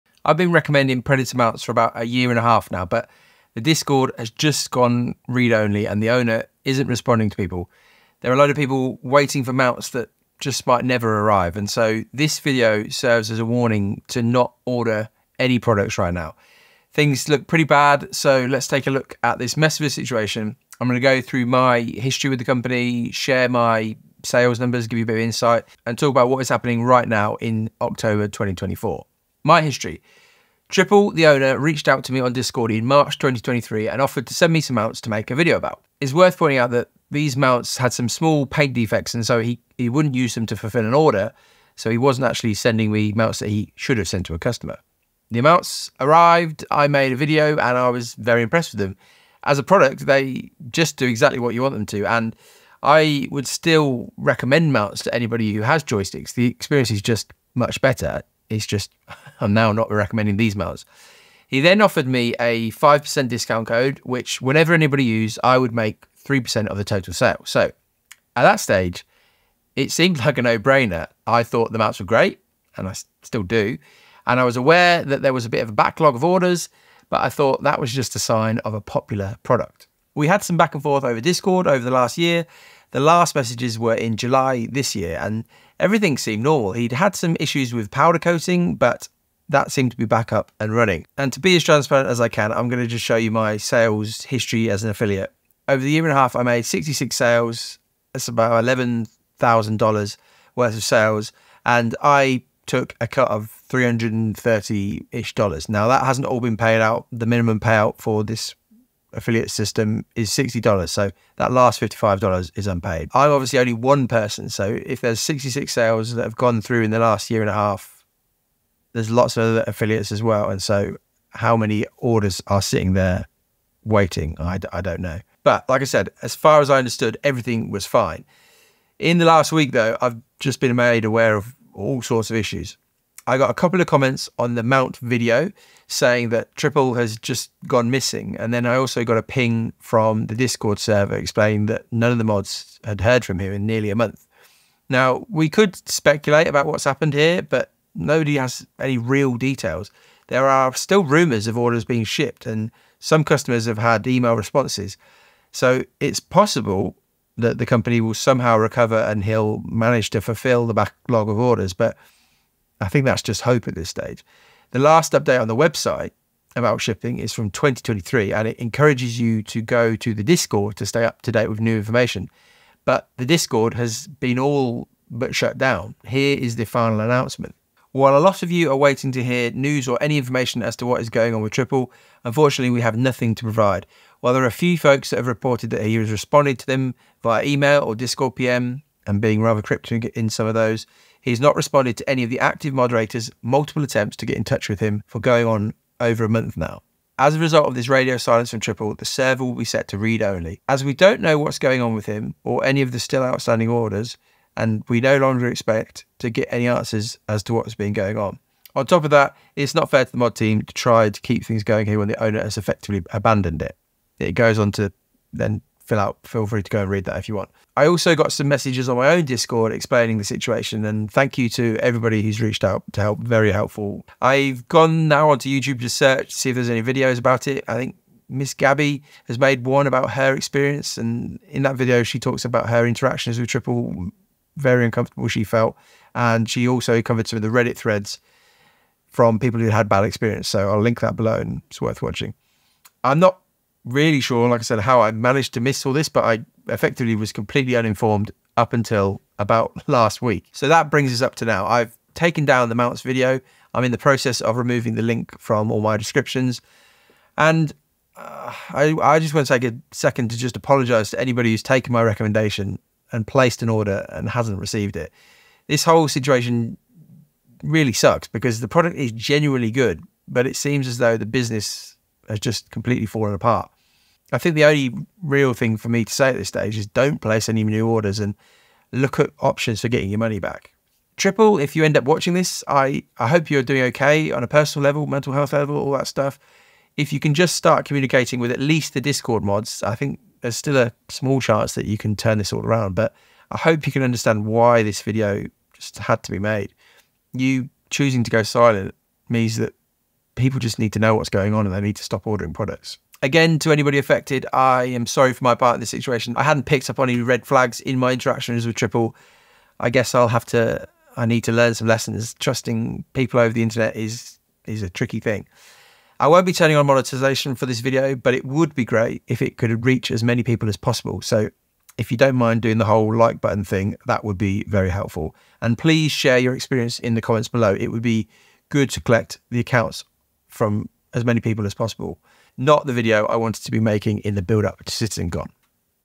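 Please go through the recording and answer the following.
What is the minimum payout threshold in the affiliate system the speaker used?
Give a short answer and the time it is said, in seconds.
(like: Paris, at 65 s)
$60, at 110 s.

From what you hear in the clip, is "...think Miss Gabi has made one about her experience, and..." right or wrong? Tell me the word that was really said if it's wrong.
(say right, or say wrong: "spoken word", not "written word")
right.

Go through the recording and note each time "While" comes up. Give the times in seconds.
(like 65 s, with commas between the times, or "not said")
177 s, 184 s.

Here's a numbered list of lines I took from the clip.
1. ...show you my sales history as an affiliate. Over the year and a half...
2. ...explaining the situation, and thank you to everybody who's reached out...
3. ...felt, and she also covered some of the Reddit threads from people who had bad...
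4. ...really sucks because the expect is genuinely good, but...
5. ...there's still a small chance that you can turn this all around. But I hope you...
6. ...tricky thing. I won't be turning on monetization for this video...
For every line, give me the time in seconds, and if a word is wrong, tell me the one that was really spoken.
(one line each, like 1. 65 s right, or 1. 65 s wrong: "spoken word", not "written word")
1. 93 s right
2. 219 s right
3. 235 s right
4. 267 s wrong: "product", not "expect"
5. 290 s right
6. 314 s right.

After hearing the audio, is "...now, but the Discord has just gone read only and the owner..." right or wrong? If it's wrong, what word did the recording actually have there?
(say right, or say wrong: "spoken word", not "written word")
right.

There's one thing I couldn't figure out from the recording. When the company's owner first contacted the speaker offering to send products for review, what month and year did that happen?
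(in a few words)
March 2023.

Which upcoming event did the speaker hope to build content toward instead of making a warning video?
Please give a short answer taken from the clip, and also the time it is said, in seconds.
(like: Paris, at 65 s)
CitizenCon, at 334 s.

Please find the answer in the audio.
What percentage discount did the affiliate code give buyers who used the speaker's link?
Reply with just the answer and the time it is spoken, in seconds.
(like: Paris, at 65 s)
5%, at 62 s.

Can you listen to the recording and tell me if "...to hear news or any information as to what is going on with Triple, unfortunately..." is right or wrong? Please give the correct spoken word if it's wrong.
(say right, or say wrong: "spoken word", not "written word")
right.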